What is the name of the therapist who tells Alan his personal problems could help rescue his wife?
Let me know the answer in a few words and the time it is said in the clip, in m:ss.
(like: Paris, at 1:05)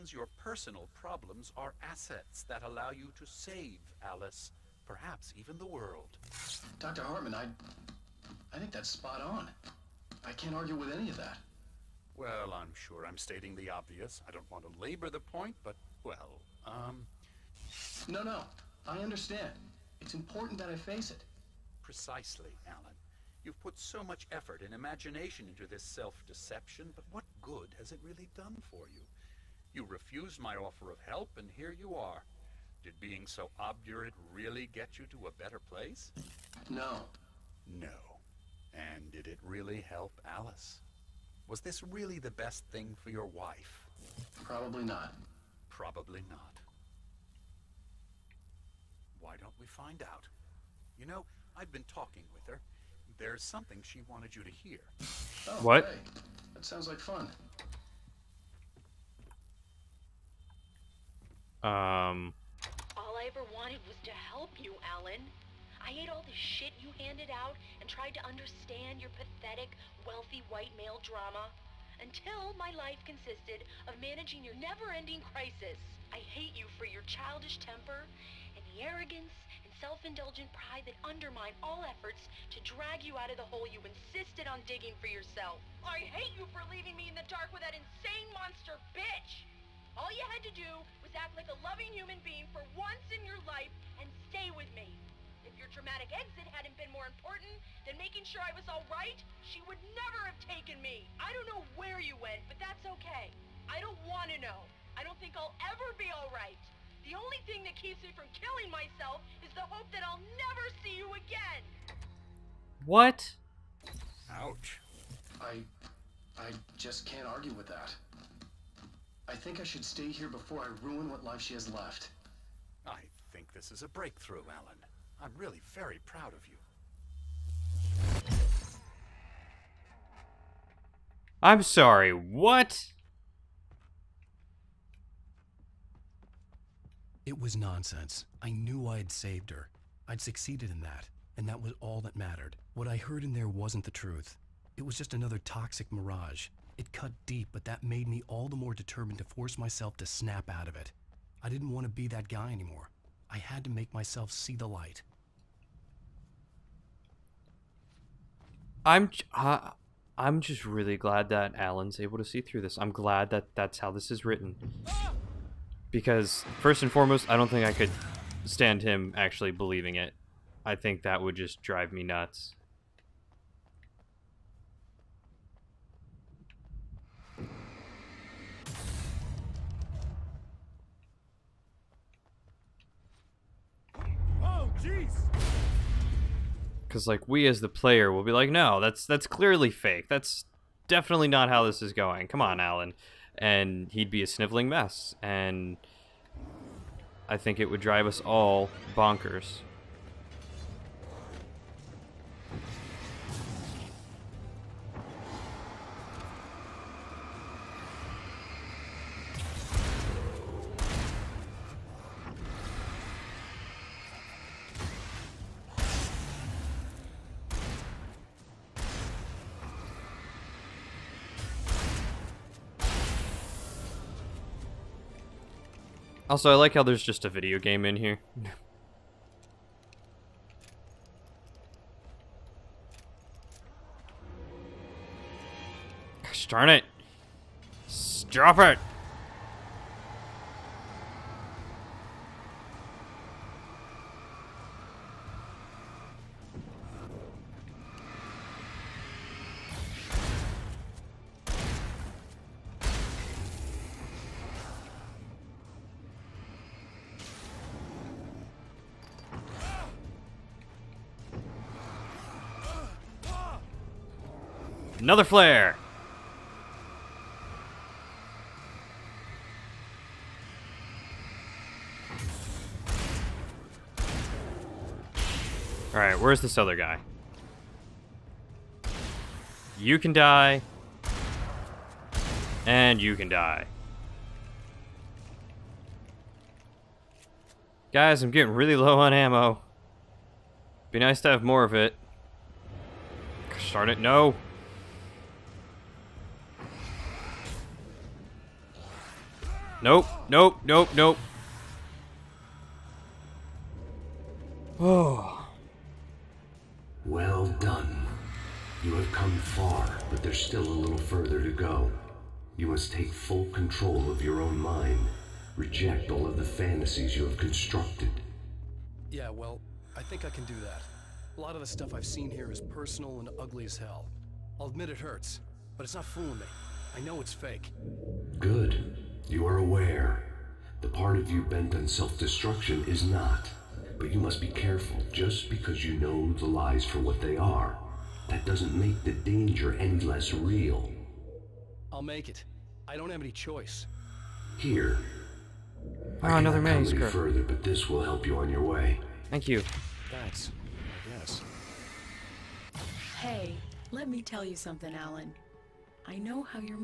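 Dr. Hartman, at 0:06.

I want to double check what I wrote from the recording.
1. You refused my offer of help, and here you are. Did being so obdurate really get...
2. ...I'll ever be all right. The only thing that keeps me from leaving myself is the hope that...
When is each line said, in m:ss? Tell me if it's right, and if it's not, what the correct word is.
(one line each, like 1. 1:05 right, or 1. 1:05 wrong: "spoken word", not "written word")
1. 0:29 right
2. 1:45 wrong: "killing", not "leaving".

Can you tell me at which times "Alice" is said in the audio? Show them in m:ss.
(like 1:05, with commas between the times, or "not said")
0:04, 0:40.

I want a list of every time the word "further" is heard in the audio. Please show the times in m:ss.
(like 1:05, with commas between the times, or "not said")
5:10, 5:46.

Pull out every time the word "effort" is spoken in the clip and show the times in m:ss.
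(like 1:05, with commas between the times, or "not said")
0:24, 1:21.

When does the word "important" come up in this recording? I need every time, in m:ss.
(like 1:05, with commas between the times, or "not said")
0:20, 1:37.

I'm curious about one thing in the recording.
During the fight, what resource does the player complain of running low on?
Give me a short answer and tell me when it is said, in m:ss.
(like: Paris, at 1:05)
ammo, at 4:49.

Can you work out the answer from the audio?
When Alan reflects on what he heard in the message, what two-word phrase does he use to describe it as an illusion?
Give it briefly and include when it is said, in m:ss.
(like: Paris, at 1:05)
toxic mirage, at 2:25.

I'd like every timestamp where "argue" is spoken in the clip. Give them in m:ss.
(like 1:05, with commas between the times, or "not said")
0:10, 1:57.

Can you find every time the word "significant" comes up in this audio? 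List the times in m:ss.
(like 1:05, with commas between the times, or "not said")
not said.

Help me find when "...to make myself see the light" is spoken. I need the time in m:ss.
2:33.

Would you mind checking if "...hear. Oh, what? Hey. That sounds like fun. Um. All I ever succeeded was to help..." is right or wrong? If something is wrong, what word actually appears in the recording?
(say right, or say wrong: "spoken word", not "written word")
wrong: "wanted", not "succeeded".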